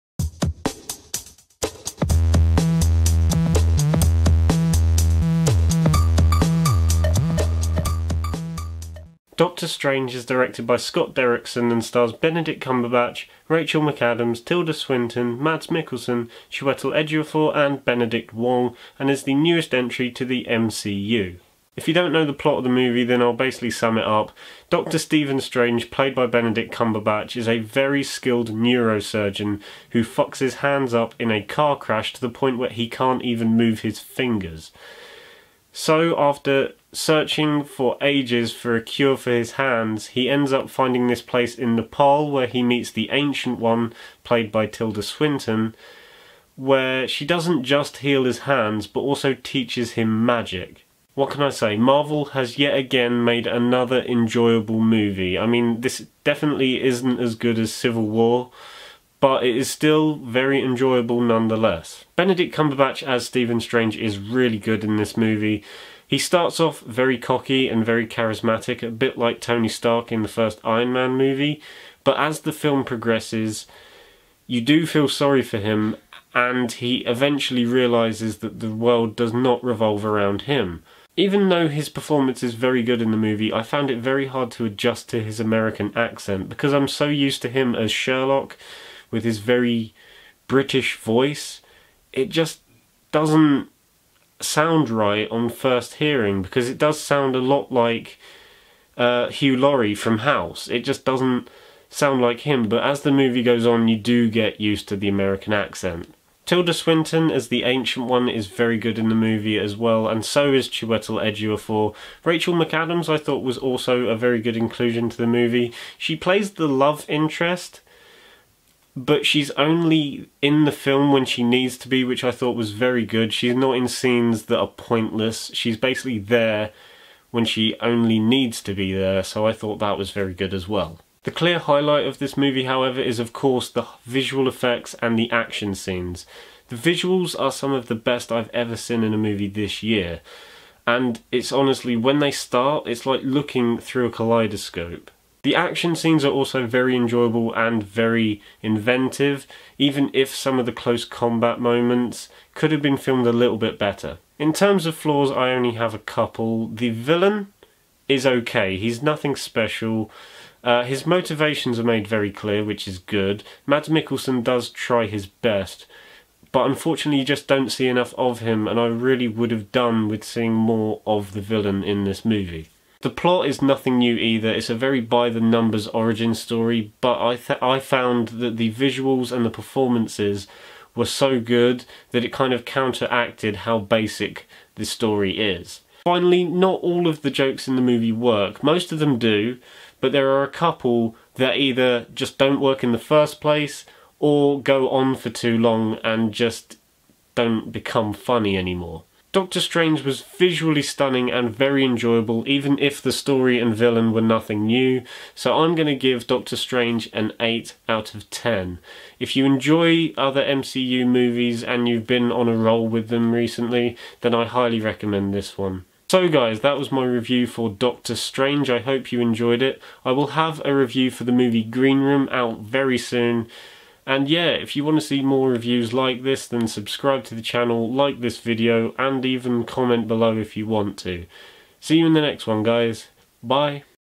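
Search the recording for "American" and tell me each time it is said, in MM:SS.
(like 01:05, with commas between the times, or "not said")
01:25, 01:45.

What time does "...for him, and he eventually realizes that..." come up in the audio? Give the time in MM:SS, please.
01:15.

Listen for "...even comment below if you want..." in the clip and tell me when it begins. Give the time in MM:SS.
03:49.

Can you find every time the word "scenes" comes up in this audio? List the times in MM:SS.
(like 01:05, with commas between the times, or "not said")
02:03, 02:15, 02:25.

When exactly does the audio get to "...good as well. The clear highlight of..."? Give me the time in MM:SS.
02:10.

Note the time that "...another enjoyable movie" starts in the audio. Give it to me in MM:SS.
00:53.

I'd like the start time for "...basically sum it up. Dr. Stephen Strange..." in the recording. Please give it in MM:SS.
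00:23.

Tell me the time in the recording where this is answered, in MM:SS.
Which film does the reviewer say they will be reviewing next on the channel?
03:41.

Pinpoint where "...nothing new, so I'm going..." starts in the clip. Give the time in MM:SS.
03:24.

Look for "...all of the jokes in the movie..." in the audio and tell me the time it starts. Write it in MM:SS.
03:06.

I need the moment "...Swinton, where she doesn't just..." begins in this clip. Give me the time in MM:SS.
00:45.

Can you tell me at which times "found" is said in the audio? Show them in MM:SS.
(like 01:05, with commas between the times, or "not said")
01:23, 02:57.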